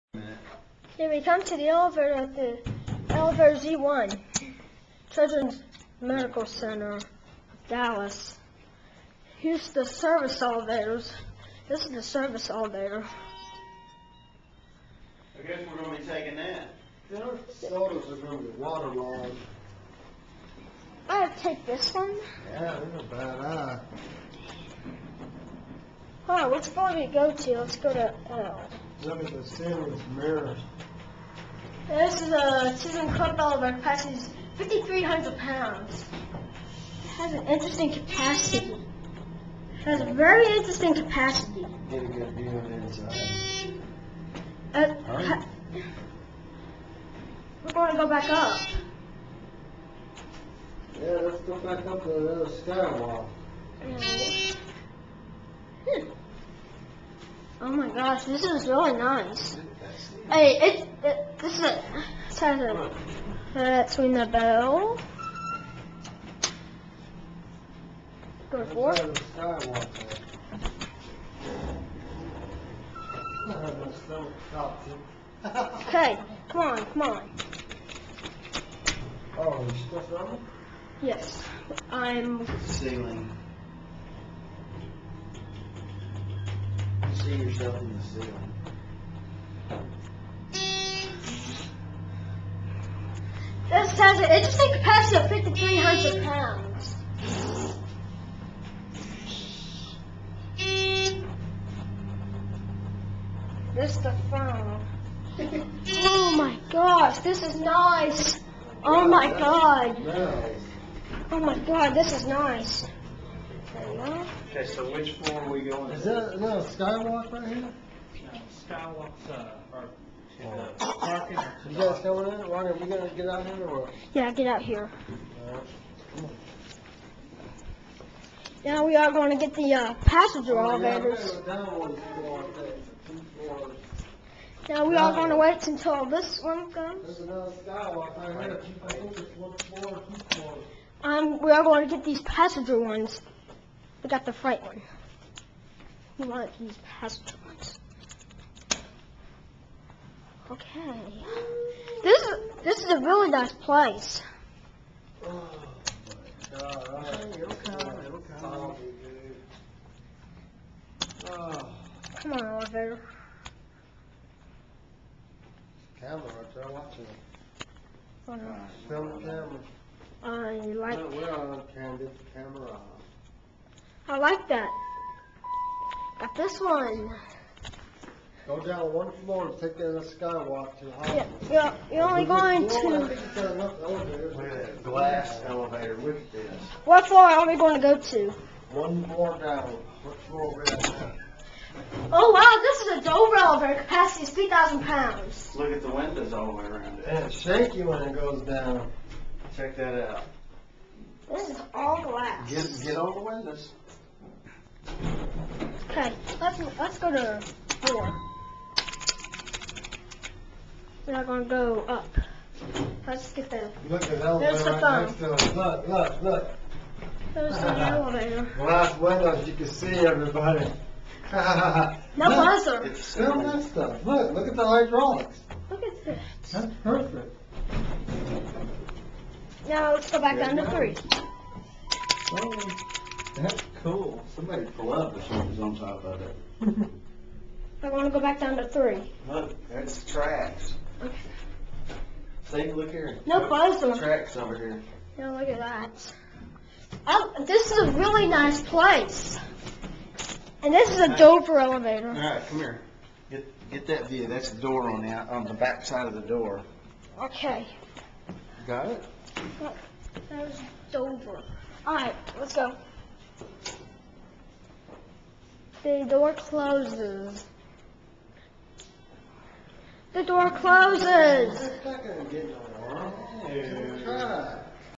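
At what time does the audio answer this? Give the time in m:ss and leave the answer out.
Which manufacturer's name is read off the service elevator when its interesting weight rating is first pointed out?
0:32.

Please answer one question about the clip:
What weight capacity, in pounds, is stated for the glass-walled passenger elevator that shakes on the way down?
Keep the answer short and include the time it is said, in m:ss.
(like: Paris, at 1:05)
3,000 pounds, at 3:14.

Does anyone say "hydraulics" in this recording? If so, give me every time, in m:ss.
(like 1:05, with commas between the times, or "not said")
3:44.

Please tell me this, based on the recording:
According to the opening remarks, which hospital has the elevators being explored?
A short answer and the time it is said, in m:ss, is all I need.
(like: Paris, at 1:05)
Children's Medical Center, Dallas, at 0:05.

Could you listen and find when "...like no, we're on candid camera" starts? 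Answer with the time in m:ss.
2:50.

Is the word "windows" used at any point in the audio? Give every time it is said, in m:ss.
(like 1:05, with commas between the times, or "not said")
3:15, 3:23, 3:38.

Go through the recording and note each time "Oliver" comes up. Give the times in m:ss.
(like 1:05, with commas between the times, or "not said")
0:33, 2:42.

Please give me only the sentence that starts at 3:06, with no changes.
what floor are we going to go to?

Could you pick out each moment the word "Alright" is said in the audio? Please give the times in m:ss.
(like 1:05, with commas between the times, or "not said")
2:05, 4:21.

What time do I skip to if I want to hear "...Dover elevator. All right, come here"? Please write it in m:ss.
4:11.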